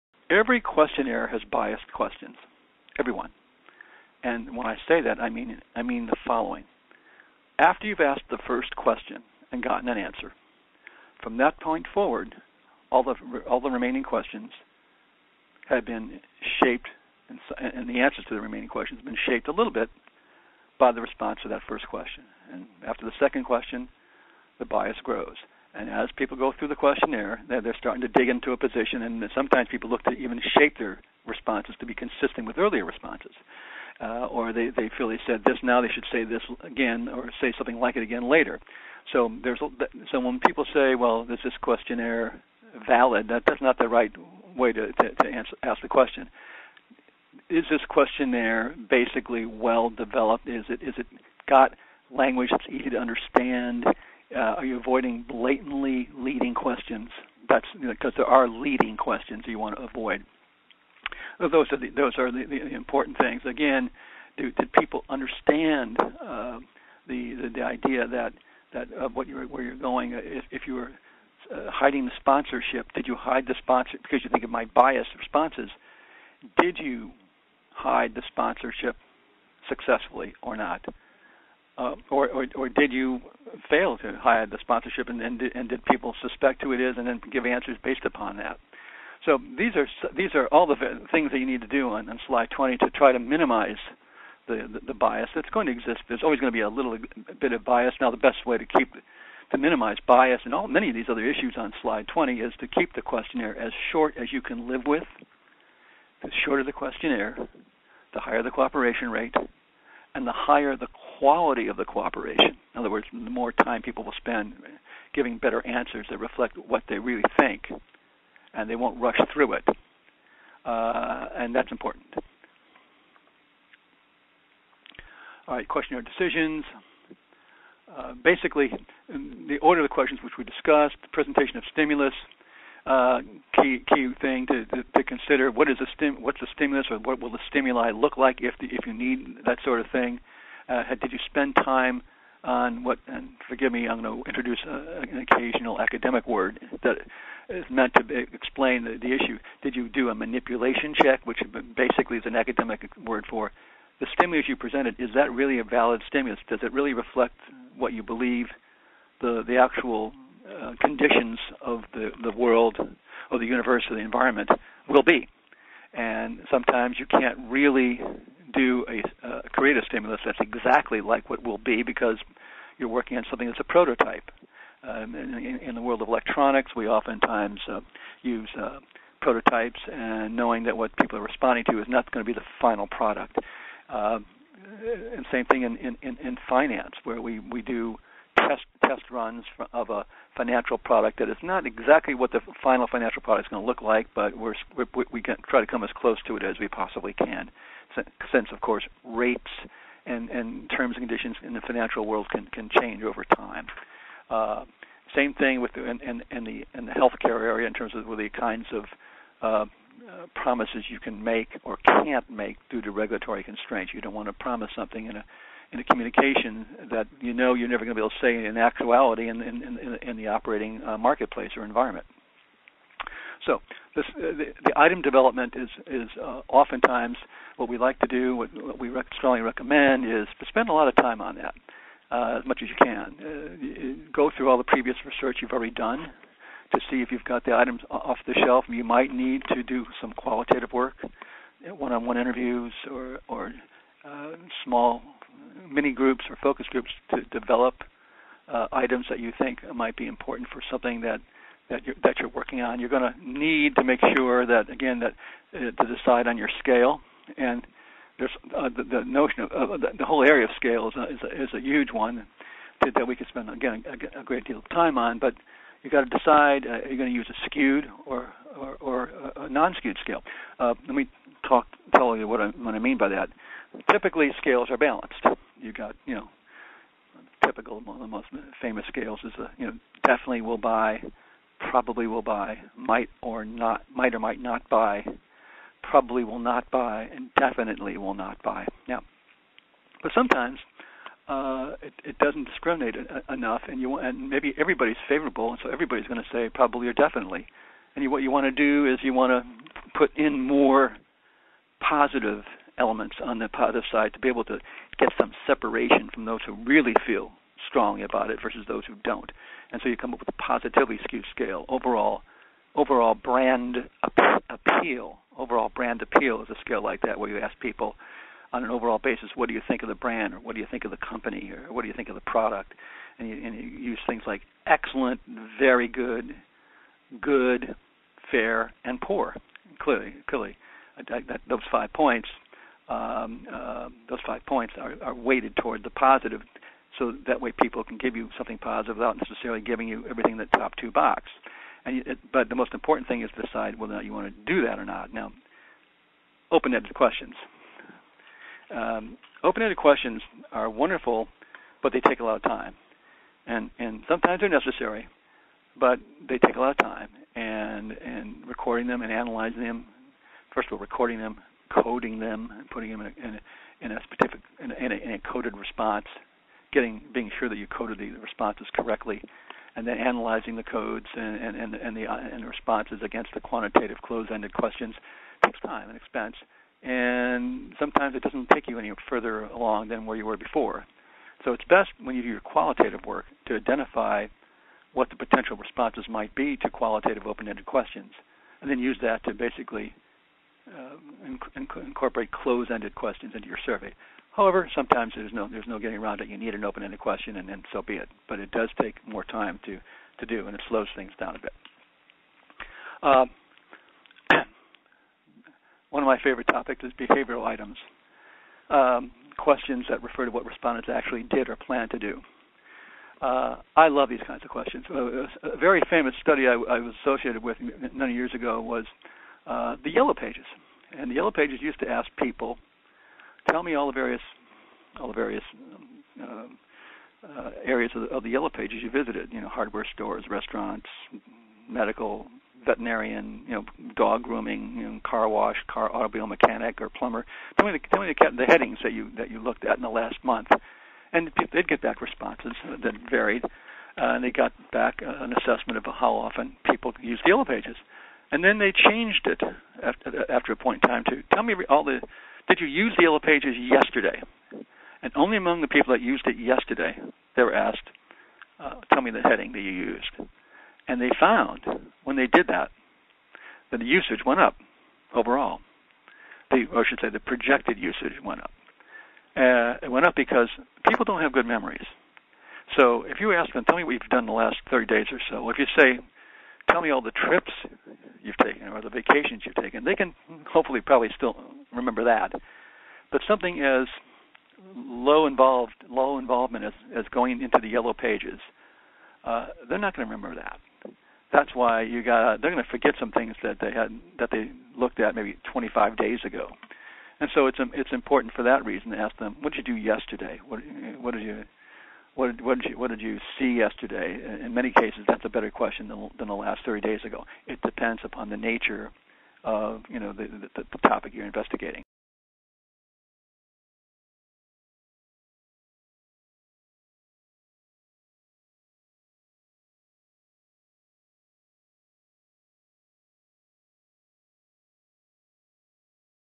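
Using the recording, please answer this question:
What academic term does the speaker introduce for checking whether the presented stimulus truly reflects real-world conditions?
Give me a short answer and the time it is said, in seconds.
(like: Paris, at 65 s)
manipulation check, at 150 s.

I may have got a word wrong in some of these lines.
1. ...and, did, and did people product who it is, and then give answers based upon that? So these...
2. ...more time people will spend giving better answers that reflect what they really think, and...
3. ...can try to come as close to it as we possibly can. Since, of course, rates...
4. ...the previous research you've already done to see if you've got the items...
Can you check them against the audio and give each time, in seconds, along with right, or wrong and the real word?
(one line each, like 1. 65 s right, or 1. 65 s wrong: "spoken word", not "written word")
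1. 85 s wrong: "suspect", not "product"
2. 113 s right
3. 195 s right
4. 234 s right.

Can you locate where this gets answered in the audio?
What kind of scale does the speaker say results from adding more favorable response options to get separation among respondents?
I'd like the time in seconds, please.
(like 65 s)
310 s.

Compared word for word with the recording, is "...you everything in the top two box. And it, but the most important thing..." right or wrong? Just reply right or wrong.
right.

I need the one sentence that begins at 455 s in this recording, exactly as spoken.
And only among the people that used it yesterday, they were asked, uh, tell me the heading that you used.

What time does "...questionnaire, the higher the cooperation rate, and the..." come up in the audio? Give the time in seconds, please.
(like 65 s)
106 s.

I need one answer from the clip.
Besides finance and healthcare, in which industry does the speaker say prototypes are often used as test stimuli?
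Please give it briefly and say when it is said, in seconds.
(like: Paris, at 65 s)
electronics, at 176 s.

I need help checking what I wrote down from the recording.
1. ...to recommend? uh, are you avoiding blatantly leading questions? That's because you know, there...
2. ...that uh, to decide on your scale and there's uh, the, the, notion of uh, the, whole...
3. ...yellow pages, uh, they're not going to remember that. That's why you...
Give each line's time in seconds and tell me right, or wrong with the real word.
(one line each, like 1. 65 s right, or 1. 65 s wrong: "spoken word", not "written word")
1. 52 s wrong: "understand", not "recommend"
2. 254 s right
3. 487 s right.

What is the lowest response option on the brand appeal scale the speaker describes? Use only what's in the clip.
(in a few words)
poor.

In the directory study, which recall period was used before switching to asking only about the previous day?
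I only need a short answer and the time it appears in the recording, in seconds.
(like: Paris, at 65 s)
last month, at 439 s.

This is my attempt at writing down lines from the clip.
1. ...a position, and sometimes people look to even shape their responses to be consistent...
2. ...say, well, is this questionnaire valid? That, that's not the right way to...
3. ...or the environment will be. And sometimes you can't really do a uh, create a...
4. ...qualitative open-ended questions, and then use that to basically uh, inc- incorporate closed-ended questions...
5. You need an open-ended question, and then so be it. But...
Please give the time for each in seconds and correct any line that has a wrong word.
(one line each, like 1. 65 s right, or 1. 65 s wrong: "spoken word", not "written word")
1. 28 s right
2. 40 s right
3. 163 s right
4. 386 s right
5. 396 s right.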